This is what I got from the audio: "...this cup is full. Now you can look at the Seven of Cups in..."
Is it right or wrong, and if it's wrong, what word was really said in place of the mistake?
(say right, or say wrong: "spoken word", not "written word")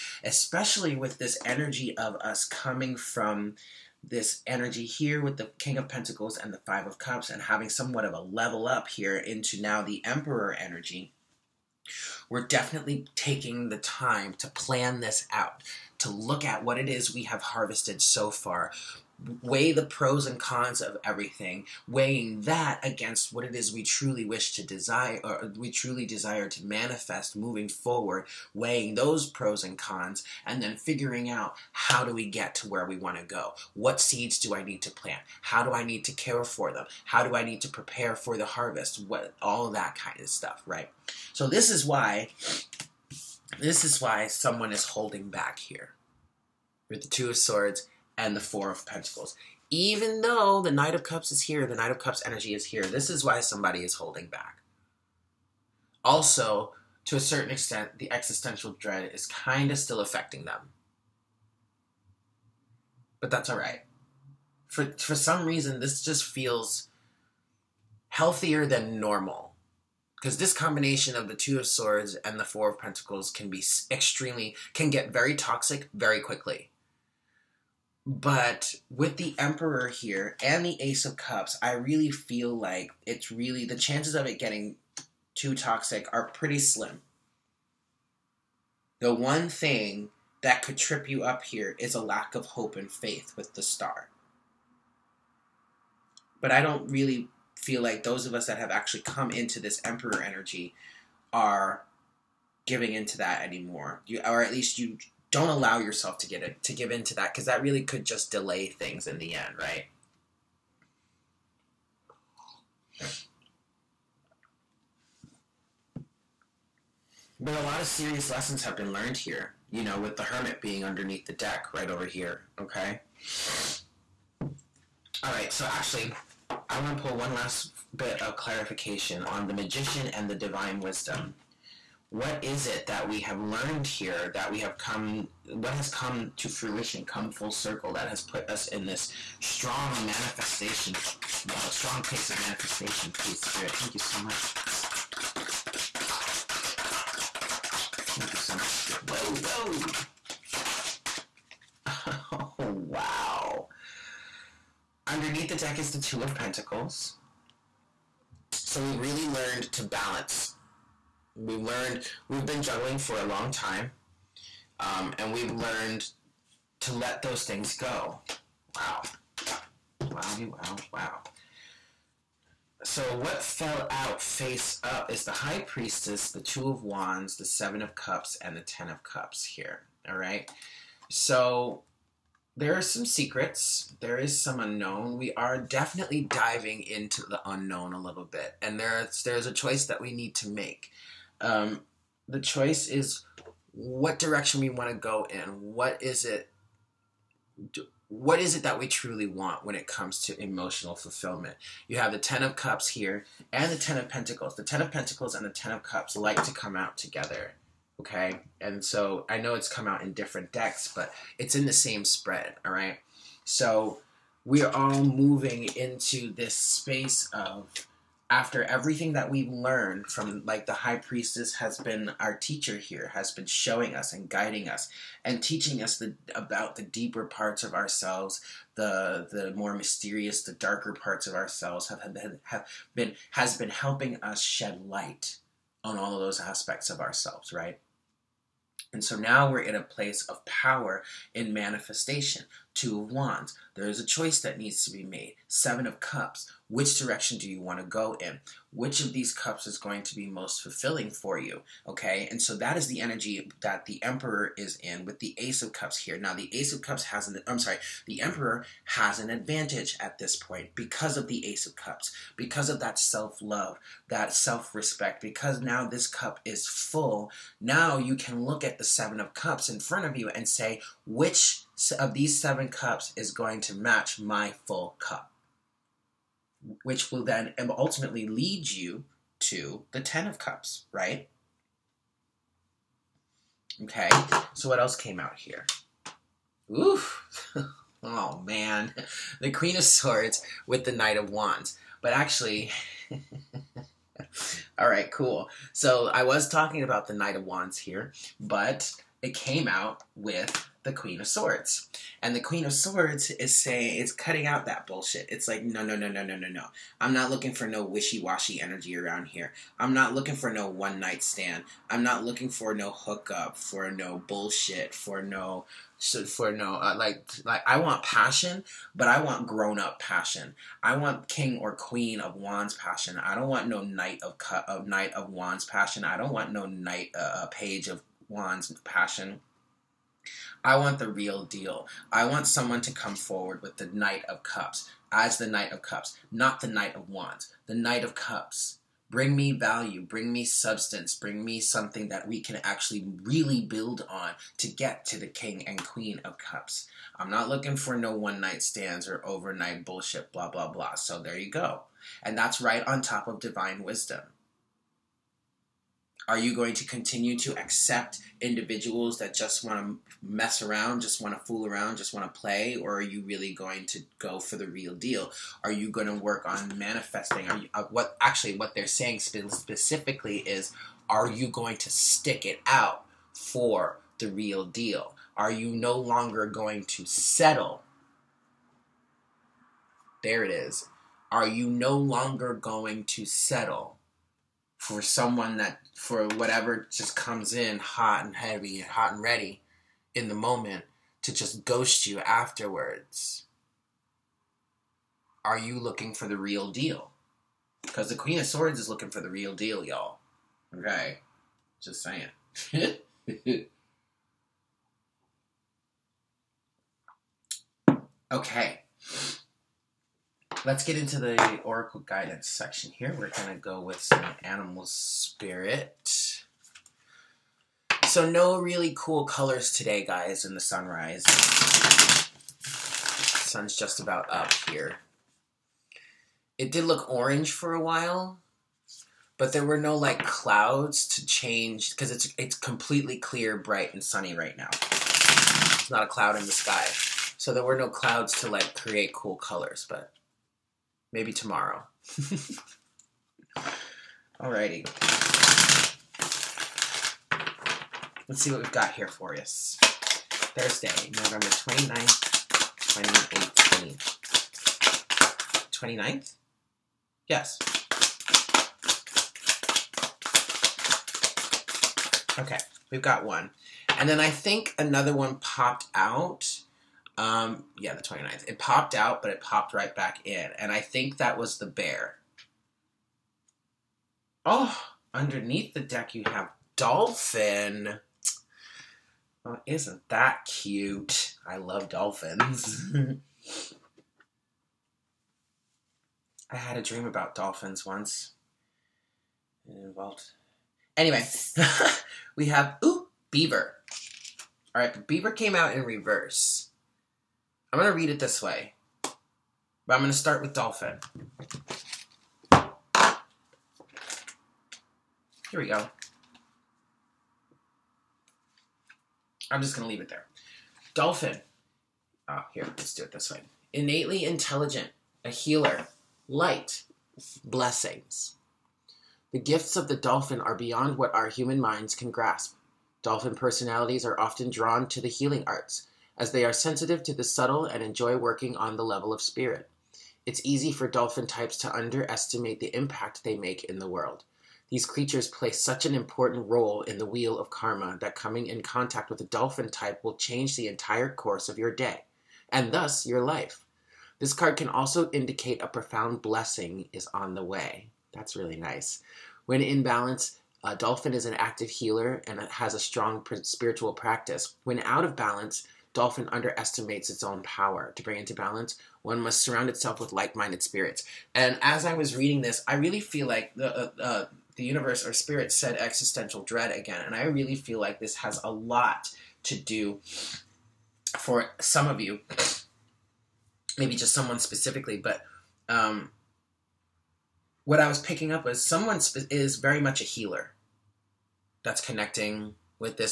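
right.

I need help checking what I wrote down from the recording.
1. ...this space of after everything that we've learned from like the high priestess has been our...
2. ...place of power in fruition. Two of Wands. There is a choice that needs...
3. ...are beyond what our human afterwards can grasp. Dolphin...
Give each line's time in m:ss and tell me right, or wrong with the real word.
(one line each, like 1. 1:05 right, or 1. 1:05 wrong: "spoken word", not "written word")
1. 3:36 right
2. 3:59 wrong: "manifestation", not "fruition"
3. 8:40 wrong: "minds", not "afterwards".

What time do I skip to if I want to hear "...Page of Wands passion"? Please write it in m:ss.
5:27.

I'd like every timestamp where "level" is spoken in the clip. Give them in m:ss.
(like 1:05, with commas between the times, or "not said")
0:08, 8:48.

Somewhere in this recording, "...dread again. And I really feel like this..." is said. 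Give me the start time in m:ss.
9:26.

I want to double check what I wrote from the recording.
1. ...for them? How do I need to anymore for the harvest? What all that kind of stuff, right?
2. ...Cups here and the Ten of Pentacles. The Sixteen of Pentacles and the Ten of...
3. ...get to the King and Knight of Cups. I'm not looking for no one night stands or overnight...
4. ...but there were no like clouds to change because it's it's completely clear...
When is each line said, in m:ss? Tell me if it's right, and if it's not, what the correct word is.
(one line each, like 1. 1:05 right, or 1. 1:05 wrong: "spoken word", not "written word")
1. 0:36 wrong: "prepare", not "anymore"
2. 3:22 wrong: "Ten", not "Sixteen"
3. 5:44 wrong: "Queen", not "Knight"
4. 7:09 right.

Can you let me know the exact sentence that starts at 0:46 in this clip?
With the two of swords, and the Four of Pentacles.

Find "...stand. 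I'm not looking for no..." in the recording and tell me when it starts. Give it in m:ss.
5:11.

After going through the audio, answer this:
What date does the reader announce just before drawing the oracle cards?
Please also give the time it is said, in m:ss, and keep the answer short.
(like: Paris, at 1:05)
Thursday, November 29th, 2018, at 7:29.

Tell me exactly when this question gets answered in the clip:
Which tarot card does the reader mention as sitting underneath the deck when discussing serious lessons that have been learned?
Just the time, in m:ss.
2:00.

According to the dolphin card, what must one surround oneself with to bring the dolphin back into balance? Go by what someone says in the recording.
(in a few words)
Like-minded spirits.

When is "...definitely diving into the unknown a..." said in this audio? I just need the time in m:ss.
3:05.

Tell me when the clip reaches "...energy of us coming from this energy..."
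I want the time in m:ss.
0:01.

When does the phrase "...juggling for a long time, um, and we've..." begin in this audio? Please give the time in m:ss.
2:42.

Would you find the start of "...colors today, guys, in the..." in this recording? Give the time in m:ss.
6:59.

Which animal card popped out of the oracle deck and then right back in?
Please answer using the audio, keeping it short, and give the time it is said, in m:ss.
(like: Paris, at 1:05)
Bear, at 7:51.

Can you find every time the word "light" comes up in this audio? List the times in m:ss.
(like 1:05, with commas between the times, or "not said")
3:54, 8:36.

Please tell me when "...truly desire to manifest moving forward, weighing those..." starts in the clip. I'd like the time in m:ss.
0:25.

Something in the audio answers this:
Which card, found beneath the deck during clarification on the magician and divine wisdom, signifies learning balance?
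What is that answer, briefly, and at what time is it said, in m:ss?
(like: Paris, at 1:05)
Two of Pentacles, at 2:35.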